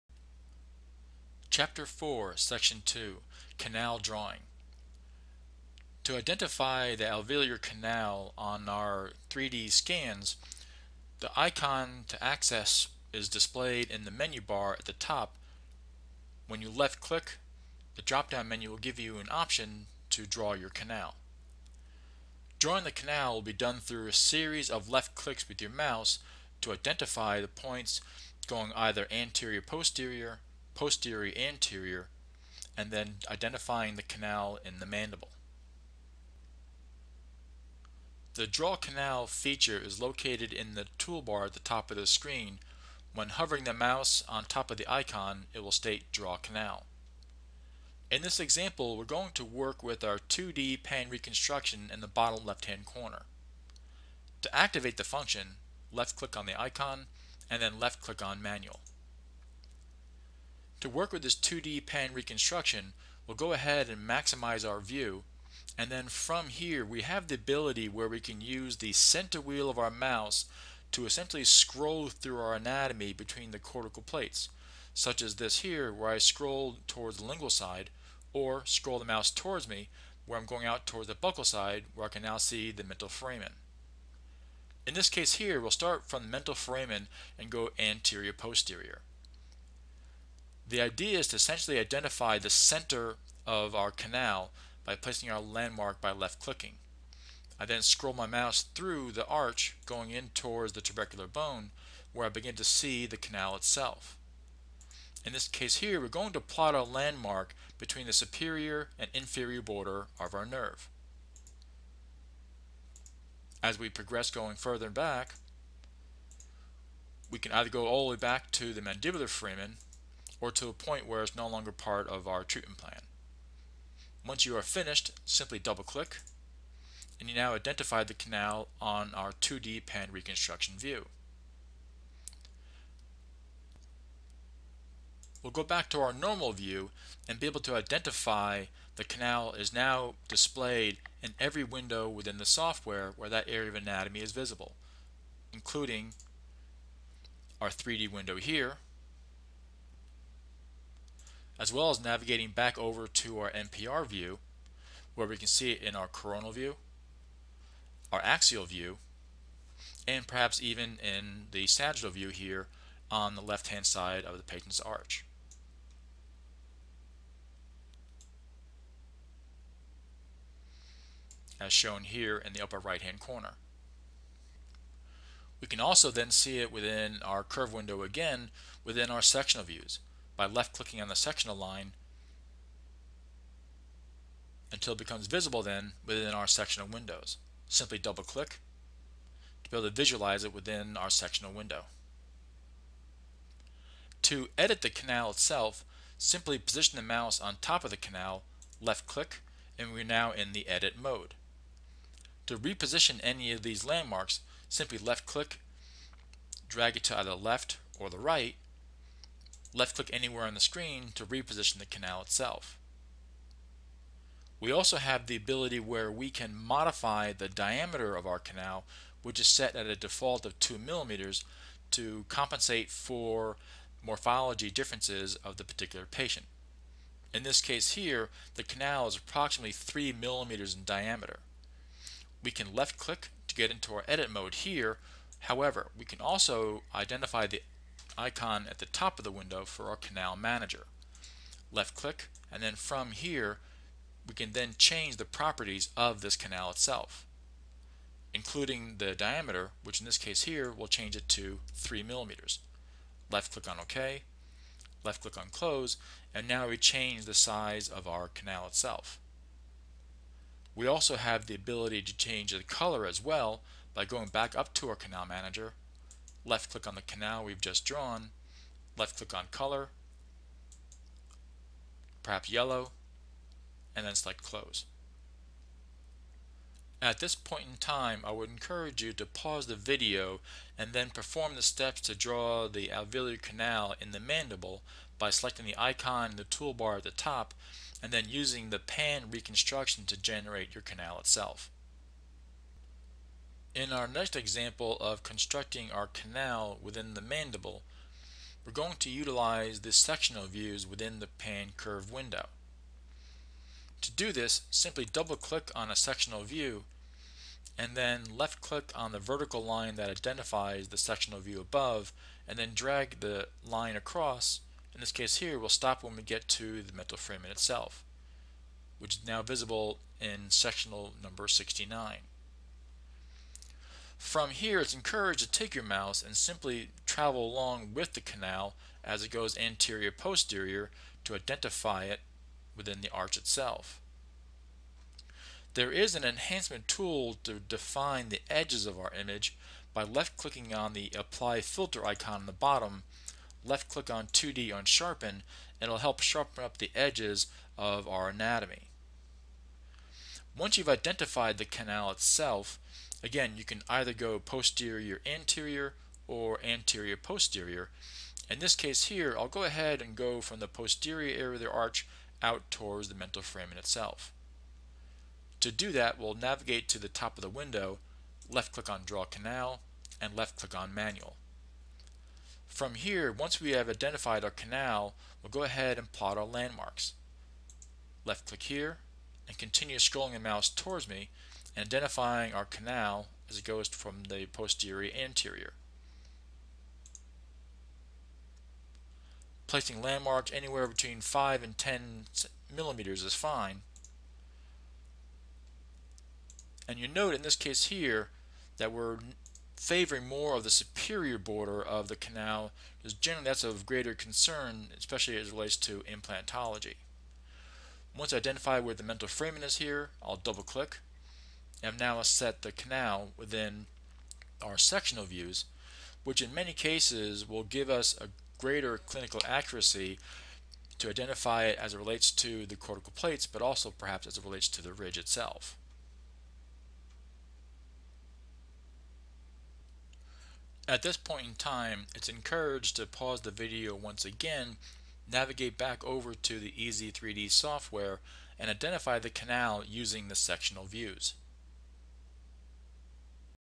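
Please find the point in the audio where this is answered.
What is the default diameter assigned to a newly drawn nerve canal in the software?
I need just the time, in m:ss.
3:40.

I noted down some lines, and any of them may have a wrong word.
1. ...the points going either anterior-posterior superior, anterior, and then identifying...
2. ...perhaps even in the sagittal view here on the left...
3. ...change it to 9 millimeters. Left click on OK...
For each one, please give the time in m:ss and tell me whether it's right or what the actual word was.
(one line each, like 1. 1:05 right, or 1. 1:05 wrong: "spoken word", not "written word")
1. 0:27 wrong: "posterior", not "superior"
2. 2:40 right
3. 4:10 wrong: "3", not "9".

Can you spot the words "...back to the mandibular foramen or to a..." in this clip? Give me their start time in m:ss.
1:58.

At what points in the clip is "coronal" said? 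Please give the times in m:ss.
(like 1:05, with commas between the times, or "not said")
2:36.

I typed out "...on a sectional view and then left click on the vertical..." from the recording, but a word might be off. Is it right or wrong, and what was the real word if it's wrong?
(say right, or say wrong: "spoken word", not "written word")
right.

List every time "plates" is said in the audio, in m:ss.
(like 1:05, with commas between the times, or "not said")
1:14, 7:03.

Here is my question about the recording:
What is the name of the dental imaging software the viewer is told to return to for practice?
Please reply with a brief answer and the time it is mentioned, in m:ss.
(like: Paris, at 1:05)
Ez3D, at 7:16.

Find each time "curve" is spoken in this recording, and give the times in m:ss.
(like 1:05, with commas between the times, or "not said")
2:57, 5:01.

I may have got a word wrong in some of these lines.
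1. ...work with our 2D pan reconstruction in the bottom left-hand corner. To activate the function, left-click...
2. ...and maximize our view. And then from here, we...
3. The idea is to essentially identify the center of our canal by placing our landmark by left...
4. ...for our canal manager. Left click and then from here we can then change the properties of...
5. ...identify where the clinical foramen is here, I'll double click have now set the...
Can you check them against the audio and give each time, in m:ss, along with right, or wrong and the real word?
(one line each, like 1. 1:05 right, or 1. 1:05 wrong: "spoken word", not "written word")
1. 0:49 right
2. 1:03 right
3. 1:30 right
4. 3:59 right
5. 6:48 wrong: "mental", not "clinical".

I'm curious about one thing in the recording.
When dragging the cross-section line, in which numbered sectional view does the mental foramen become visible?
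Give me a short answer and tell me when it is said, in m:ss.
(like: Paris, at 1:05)
69, at 5:21.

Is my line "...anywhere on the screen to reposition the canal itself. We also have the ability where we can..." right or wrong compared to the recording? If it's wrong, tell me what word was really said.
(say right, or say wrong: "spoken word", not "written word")
right.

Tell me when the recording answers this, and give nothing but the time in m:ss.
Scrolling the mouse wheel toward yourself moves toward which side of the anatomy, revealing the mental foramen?
1:21.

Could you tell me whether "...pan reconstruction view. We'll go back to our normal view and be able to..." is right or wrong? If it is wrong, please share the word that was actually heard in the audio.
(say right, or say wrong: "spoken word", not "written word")
right.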